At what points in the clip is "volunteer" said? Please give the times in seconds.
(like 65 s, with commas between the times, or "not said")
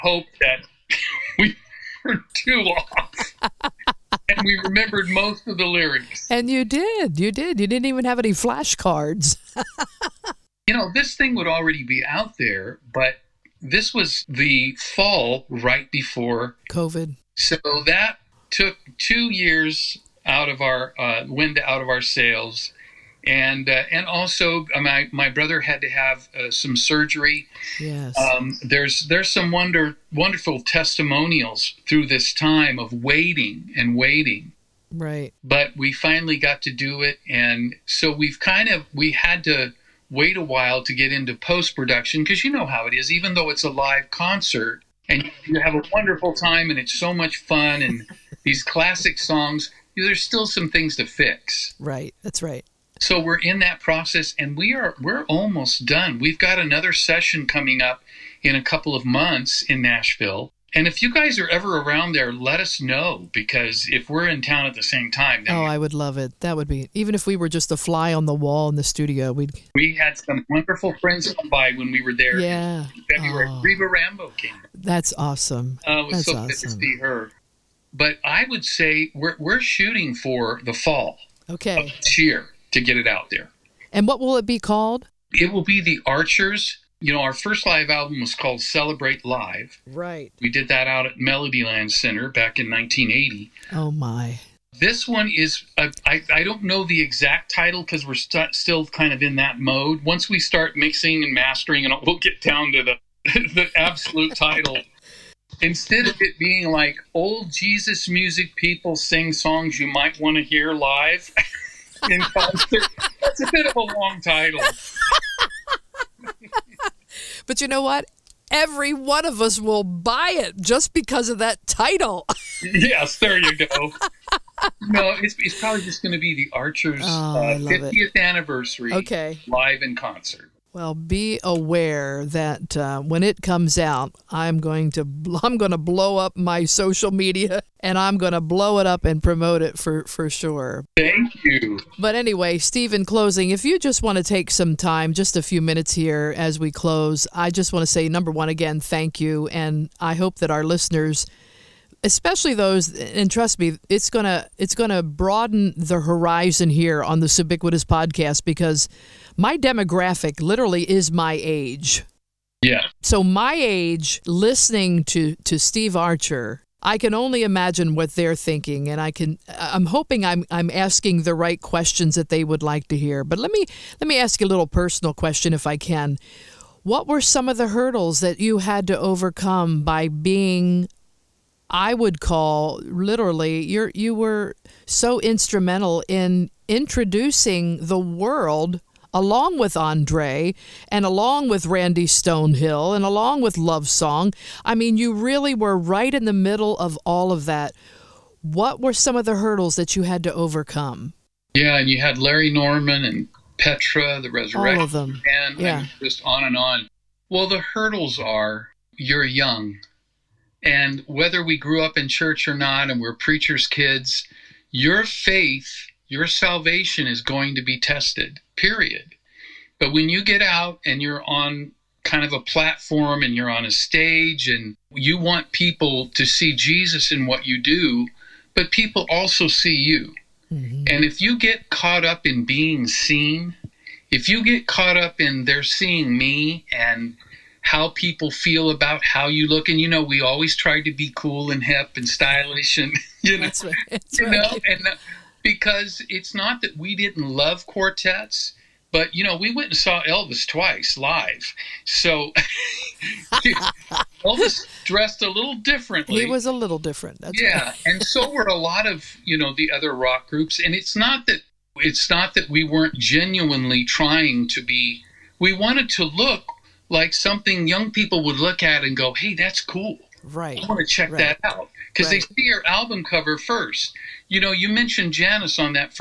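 not said.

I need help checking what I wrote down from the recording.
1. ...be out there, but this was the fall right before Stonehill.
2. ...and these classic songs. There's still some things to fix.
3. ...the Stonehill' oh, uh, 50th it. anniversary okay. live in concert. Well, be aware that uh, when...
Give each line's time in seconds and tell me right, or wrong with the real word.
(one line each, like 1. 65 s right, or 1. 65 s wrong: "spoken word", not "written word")
1. 11 s wrong: "COVID", not "Stonehill"
2. 47 s right
3. 126 s wrong: "Archers", not "Stonehill".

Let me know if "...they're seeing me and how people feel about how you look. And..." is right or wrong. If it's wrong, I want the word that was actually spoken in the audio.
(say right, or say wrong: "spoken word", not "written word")
right.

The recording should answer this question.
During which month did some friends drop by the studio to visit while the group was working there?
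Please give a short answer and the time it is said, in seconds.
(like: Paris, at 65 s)
February, at 73 s.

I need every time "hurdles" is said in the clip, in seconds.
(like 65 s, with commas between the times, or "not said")
177 s, 199 s, 207 s.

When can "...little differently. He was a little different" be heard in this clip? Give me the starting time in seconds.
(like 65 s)
255 s.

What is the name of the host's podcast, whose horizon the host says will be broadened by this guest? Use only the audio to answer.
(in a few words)
Ubiquitous.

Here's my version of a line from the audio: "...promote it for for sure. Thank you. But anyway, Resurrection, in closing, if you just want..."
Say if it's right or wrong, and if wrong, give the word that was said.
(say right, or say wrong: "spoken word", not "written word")
wrong: "Steve", not "Resurrection".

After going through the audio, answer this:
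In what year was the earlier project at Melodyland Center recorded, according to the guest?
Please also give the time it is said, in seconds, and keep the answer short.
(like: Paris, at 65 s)
1980, at 92 s.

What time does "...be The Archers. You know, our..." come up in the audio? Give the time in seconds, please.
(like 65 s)
85 s.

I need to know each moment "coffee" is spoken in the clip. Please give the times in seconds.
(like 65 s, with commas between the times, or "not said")
not said.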